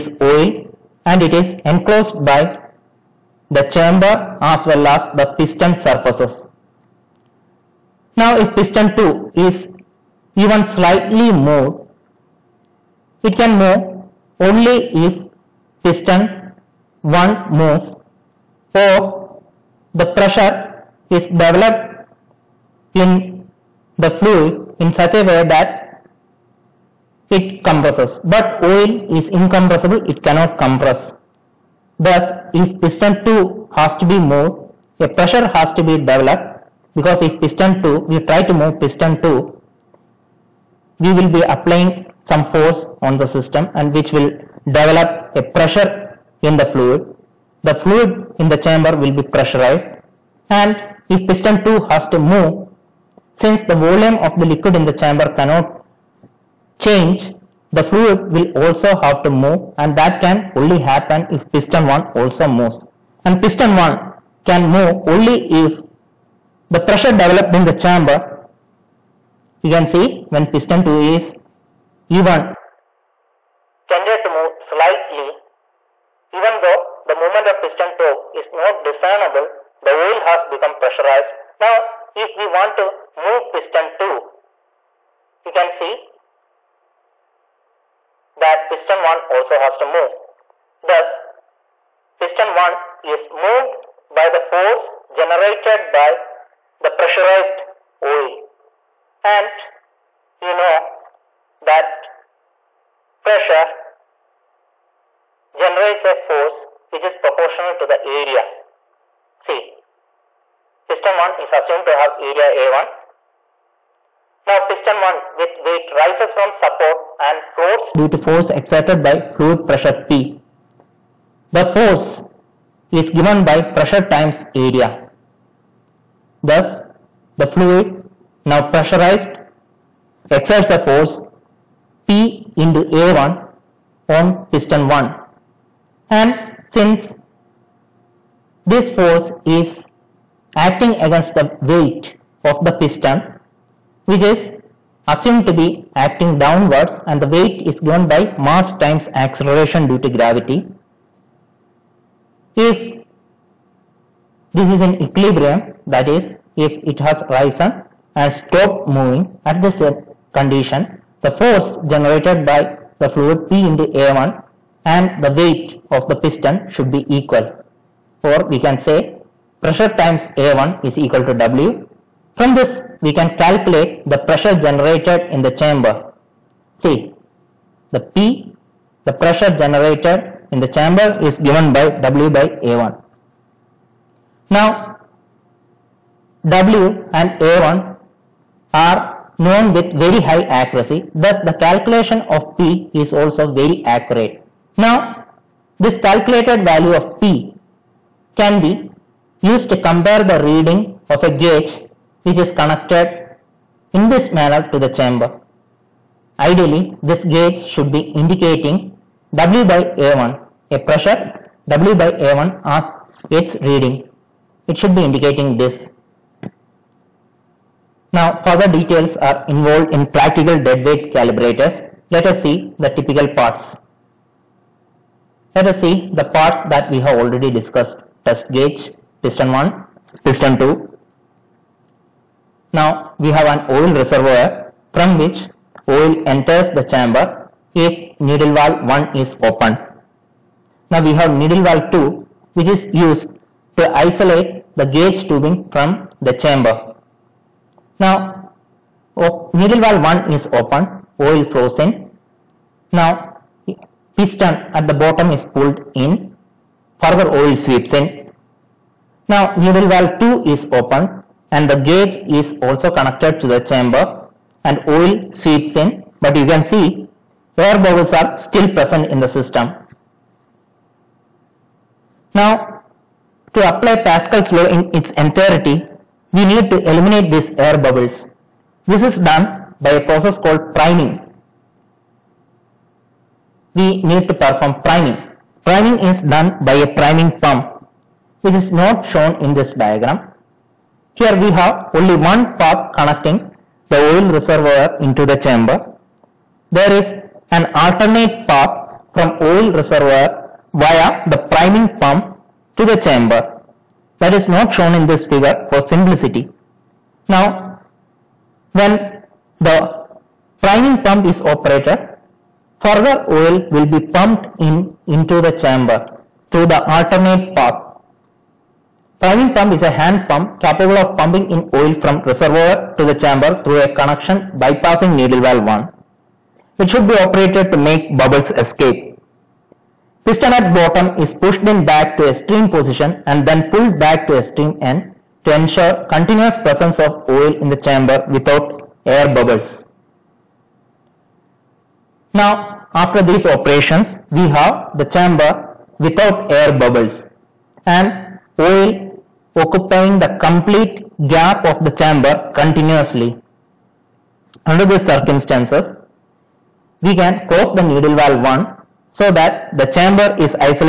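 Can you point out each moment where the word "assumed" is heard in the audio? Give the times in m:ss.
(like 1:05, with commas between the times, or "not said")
1:51, 2:25.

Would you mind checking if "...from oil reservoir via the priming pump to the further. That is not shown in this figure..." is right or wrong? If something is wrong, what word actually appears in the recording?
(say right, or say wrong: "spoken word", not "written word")
wrong: "chamber", not "further".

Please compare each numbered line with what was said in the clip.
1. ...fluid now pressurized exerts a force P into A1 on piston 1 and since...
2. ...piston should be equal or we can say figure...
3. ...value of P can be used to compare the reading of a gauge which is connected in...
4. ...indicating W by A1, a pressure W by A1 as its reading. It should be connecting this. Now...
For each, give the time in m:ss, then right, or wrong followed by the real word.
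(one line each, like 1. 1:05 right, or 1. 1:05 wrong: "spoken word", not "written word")
1. 2:07 right
2. 2:46 wrong: "pressure", not "figure"
3. 3:16 right
4. 3:28 wrong: "indicating", not "connecting".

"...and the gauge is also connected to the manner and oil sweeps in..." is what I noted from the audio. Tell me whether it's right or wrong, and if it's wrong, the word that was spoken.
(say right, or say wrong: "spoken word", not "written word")
wrong: "chamber", not "manner".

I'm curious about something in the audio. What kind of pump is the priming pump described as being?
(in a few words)
hand pump.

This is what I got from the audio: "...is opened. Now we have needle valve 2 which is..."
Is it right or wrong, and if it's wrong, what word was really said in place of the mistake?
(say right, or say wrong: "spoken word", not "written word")
right.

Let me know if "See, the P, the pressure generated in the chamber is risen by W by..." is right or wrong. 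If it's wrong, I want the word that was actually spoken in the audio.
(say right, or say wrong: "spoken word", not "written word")
wrong: "given", not "risen".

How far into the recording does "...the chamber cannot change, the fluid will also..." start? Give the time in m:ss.
0:54.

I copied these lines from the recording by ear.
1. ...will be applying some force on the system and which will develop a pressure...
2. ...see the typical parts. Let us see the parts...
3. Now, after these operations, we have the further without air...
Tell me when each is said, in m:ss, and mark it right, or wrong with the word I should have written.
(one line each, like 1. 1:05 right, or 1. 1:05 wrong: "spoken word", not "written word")
1. 0:41 right
2. 3:42 right
3. 5:42 wrong: "chamber", not "further".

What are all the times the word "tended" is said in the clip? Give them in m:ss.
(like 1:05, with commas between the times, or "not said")
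1:13.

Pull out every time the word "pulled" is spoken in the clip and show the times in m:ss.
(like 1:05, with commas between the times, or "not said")
4:15, 5:33.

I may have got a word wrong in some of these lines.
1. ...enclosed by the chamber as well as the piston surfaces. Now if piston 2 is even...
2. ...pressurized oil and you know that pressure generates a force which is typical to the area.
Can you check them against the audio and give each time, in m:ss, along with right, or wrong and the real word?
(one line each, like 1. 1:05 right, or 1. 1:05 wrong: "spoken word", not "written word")
1. 0:01 right
2. 1:36 wrong: "proportional", not "typical".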